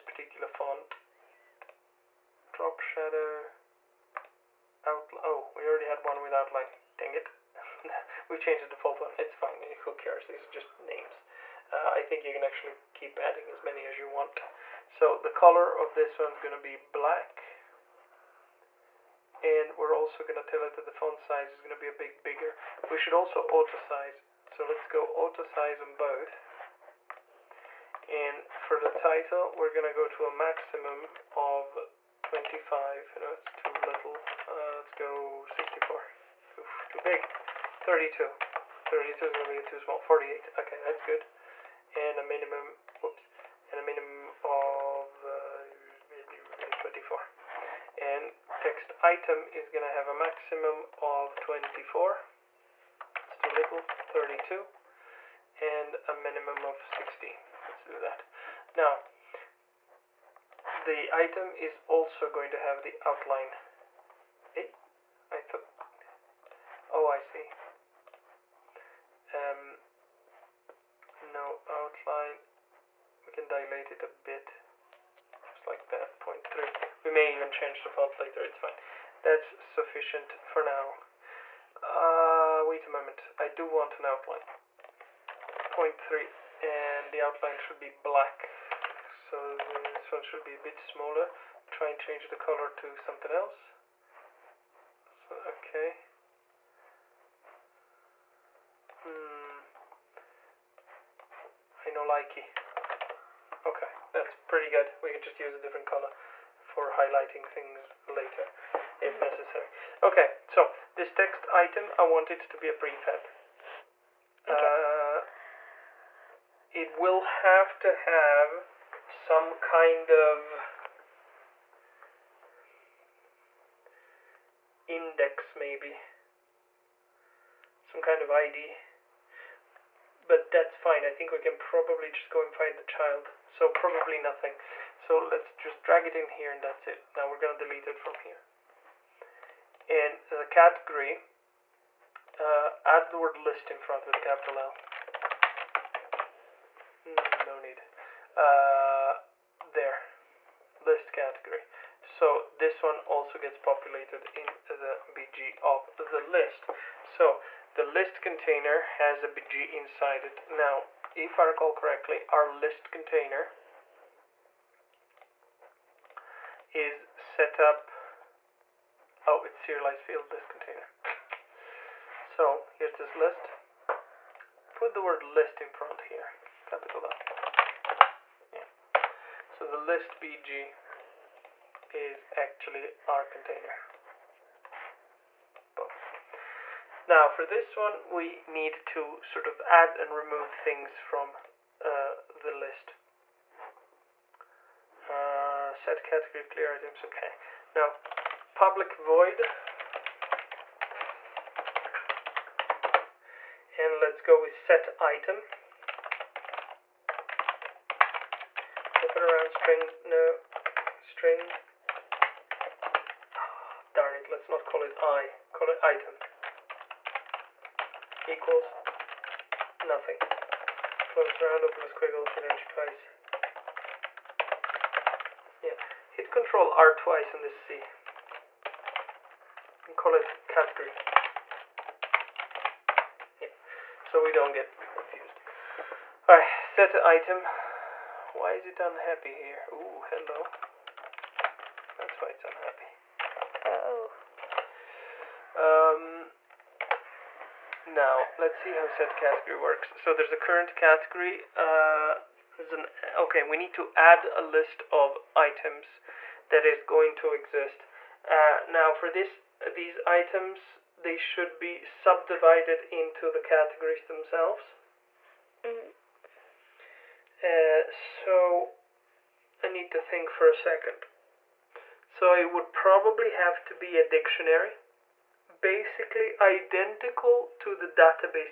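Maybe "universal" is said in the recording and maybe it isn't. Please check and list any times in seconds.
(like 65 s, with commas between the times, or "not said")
not said.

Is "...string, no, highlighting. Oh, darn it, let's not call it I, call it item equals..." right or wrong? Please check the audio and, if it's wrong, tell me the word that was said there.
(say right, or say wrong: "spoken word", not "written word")
wrong: "string", not "highlighting".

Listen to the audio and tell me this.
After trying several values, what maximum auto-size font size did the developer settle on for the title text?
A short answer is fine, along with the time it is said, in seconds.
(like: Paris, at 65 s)
48, at 39 s.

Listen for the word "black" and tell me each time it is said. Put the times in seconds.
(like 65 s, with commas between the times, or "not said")
16 s, 87 s.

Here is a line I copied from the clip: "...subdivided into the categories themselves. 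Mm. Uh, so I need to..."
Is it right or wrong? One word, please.
right.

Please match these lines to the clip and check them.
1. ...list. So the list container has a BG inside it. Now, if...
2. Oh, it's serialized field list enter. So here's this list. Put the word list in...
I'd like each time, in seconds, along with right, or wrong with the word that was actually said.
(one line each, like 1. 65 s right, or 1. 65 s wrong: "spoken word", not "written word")
1. 156 s right
2. 169 s wrong: "container", not "enter".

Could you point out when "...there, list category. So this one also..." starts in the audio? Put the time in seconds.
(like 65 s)
149 s.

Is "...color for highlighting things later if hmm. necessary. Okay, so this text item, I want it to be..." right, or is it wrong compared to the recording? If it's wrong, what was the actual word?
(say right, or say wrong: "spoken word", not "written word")
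right.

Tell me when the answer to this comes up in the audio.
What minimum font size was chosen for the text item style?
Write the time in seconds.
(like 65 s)
56 s.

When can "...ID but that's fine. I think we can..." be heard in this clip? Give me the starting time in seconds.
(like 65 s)
128 s.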